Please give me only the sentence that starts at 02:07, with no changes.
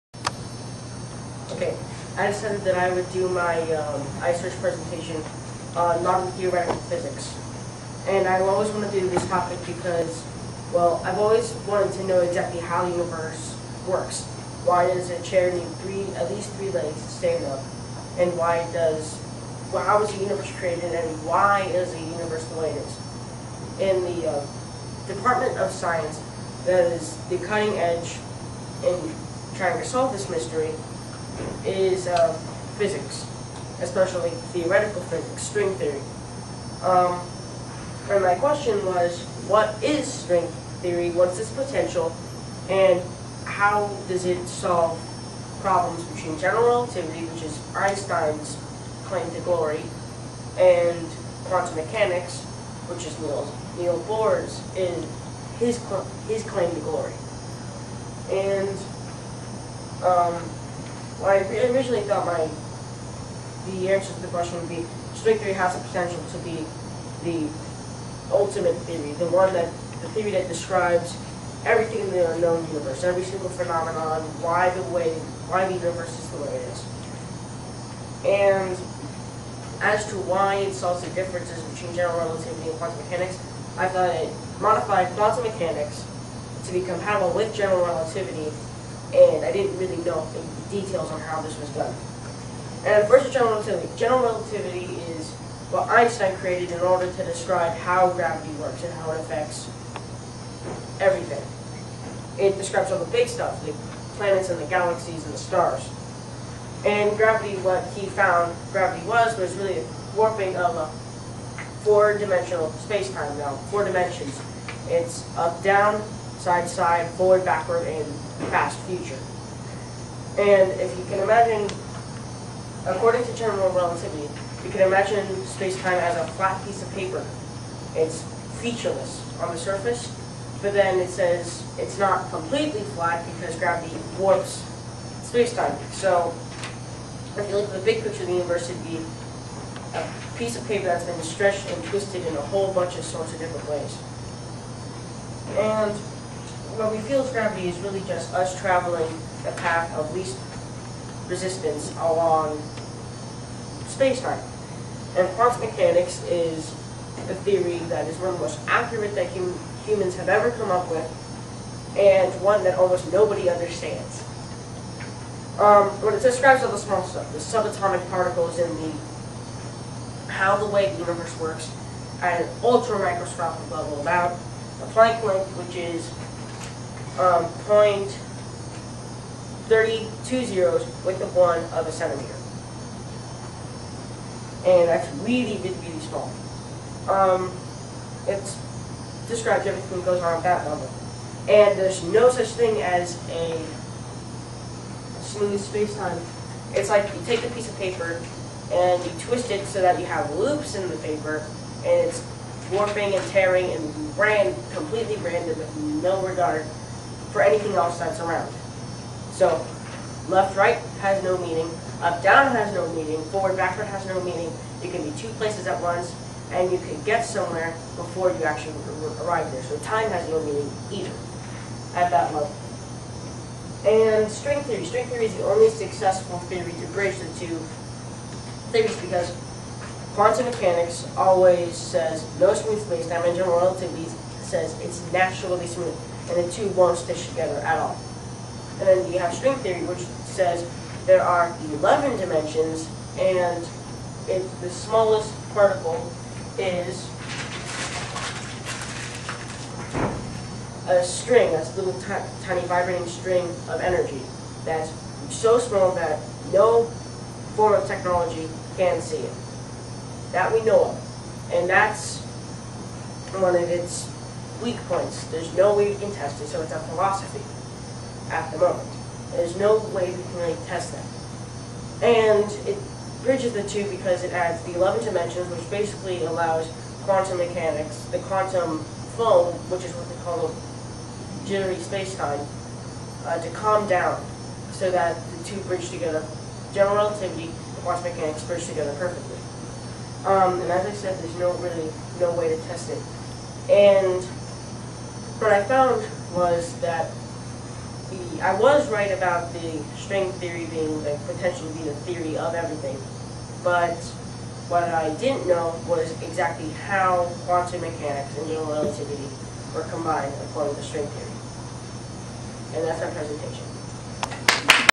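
It's featureless on the surface, but then it says it's not completely flat because gravity warps space-time.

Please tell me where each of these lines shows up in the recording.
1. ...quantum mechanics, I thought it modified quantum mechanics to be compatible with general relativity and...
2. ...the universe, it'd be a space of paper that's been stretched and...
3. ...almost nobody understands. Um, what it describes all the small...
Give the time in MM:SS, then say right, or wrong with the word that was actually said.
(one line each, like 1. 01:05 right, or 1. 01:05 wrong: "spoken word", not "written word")
1. 01:22 right
2. 02:18 wrong: "piece", not "space"
3. 02:42 right.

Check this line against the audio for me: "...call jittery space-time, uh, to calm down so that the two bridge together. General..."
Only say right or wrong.
right.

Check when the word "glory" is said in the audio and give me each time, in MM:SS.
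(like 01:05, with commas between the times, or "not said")
00:49, 00:56.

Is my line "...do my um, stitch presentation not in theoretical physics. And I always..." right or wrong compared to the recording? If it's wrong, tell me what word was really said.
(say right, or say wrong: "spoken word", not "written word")
wrong: "iSearch", not "stitch".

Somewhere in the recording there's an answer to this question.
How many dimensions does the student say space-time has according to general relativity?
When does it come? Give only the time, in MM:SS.
01:53.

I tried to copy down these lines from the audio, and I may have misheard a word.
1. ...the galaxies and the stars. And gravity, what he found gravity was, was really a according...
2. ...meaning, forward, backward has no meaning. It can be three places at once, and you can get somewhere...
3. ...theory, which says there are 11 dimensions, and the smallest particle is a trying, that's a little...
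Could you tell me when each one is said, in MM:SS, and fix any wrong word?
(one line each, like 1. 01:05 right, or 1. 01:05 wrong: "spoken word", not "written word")
1. 01:44 wrong: "warping", not "according"
2. 03:32 wrong: "two", not "three"
3. 03:59 wrong: "string", not "trying".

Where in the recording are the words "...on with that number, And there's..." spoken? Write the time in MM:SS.
03:10.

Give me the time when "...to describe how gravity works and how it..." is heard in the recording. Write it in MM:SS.
01:37.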